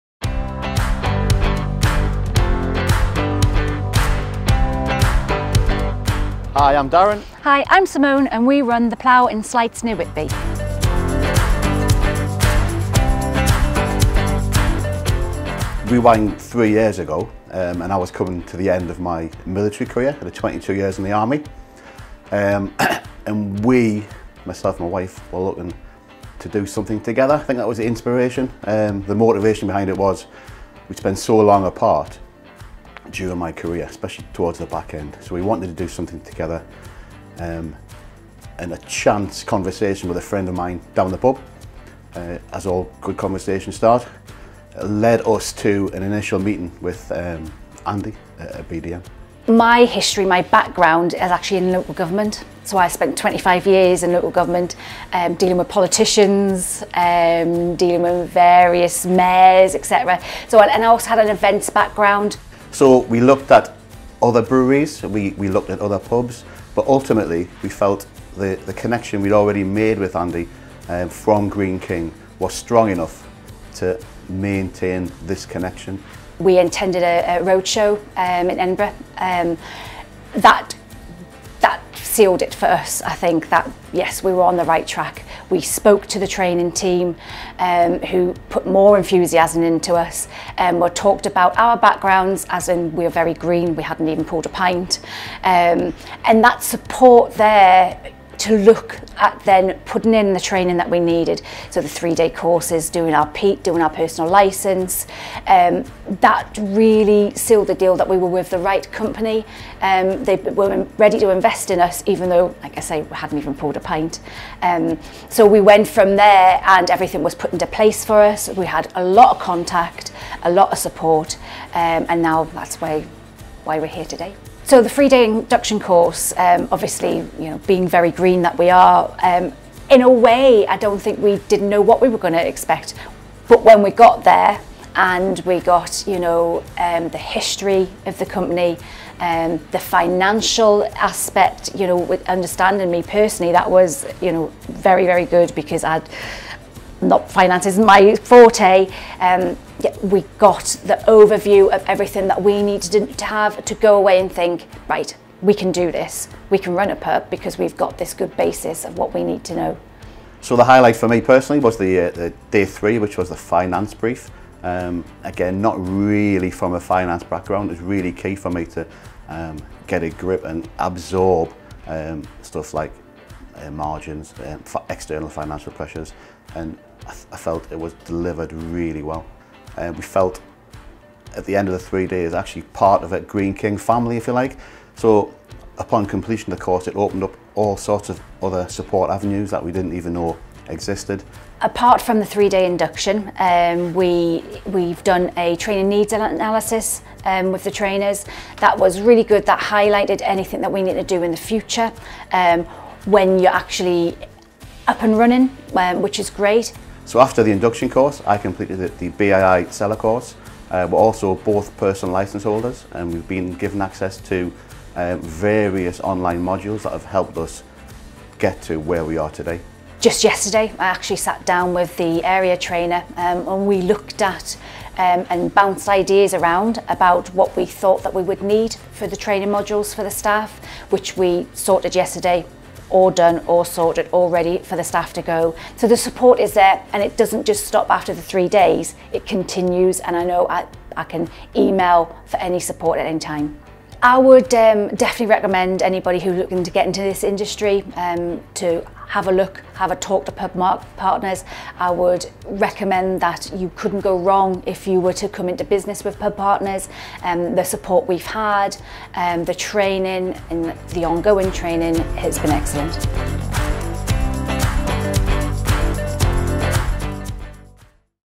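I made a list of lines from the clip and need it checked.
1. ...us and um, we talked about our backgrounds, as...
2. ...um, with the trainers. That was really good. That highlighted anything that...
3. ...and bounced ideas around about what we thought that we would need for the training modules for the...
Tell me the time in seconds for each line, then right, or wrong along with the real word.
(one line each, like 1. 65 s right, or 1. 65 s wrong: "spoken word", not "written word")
1. 89 s right
2. 197 s right
3. 225 s right.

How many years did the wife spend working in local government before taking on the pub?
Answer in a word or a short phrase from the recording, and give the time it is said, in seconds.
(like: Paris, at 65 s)
25, at 53 s.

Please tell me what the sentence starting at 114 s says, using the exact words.
Um, so we went from there and everything was put into place for us.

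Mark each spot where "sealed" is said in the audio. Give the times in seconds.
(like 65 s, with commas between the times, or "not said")
82 s, 107 s.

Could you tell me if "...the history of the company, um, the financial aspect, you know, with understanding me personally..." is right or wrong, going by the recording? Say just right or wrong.
right.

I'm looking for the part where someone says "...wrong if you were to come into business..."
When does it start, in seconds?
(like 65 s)
254 s.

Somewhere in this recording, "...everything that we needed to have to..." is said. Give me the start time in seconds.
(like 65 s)
151 s.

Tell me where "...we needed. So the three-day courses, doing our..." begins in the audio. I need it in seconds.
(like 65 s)
100 s.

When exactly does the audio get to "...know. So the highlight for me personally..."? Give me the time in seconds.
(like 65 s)
159 s.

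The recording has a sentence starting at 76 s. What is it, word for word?
We intended a, a roadshow um, in Edinburgh.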